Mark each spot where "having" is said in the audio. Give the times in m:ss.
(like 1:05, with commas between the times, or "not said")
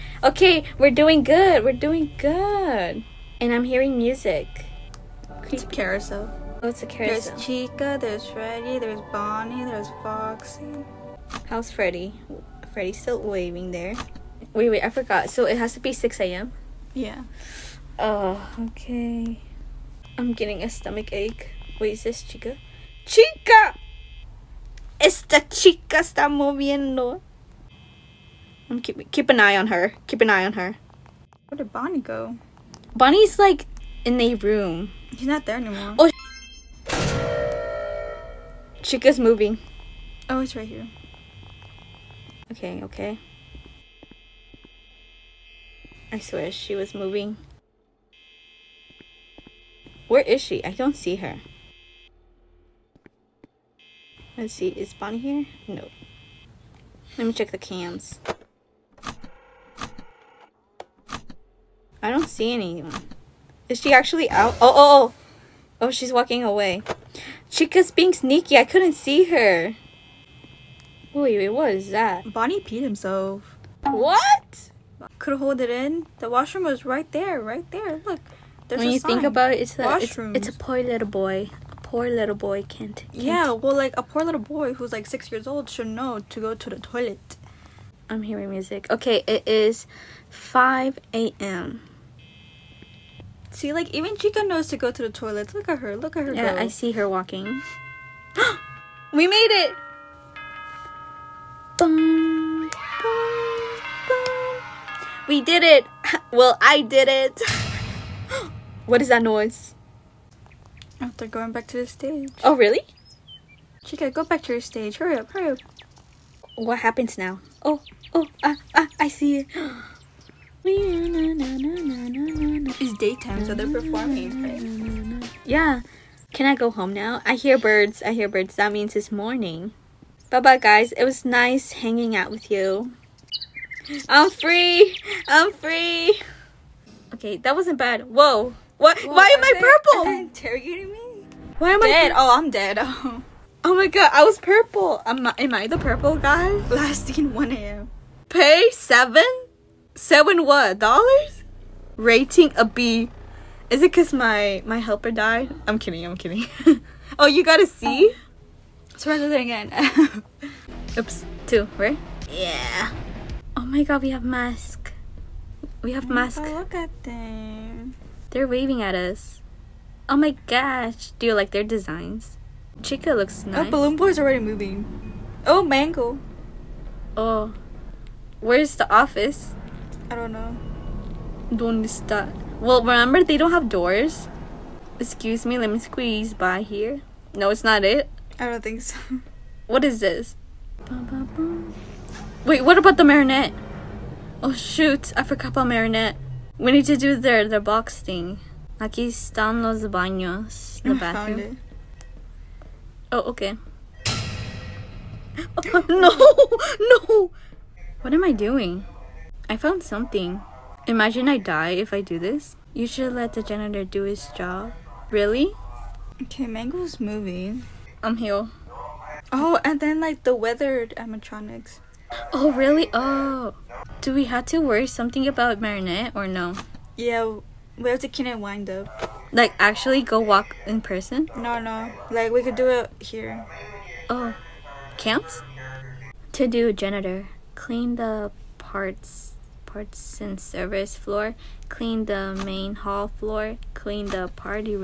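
not said.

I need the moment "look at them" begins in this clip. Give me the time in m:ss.
2:46.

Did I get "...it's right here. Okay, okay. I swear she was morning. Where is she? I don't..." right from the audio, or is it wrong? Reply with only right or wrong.
wrong.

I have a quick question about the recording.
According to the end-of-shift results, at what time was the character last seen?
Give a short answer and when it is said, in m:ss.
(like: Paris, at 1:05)
1 a.m., at 2:26.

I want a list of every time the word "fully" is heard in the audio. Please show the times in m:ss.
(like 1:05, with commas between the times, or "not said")
not said.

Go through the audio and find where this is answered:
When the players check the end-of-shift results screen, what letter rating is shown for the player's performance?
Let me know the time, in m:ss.
2:31.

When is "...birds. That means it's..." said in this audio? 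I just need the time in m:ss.
2:08.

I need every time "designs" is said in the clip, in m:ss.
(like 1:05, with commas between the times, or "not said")
2:51.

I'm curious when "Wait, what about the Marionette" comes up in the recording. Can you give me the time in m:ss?
3:12.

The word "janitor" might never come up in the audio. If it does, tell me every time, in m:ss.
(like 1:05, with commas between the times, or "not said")
3:33, 3:56.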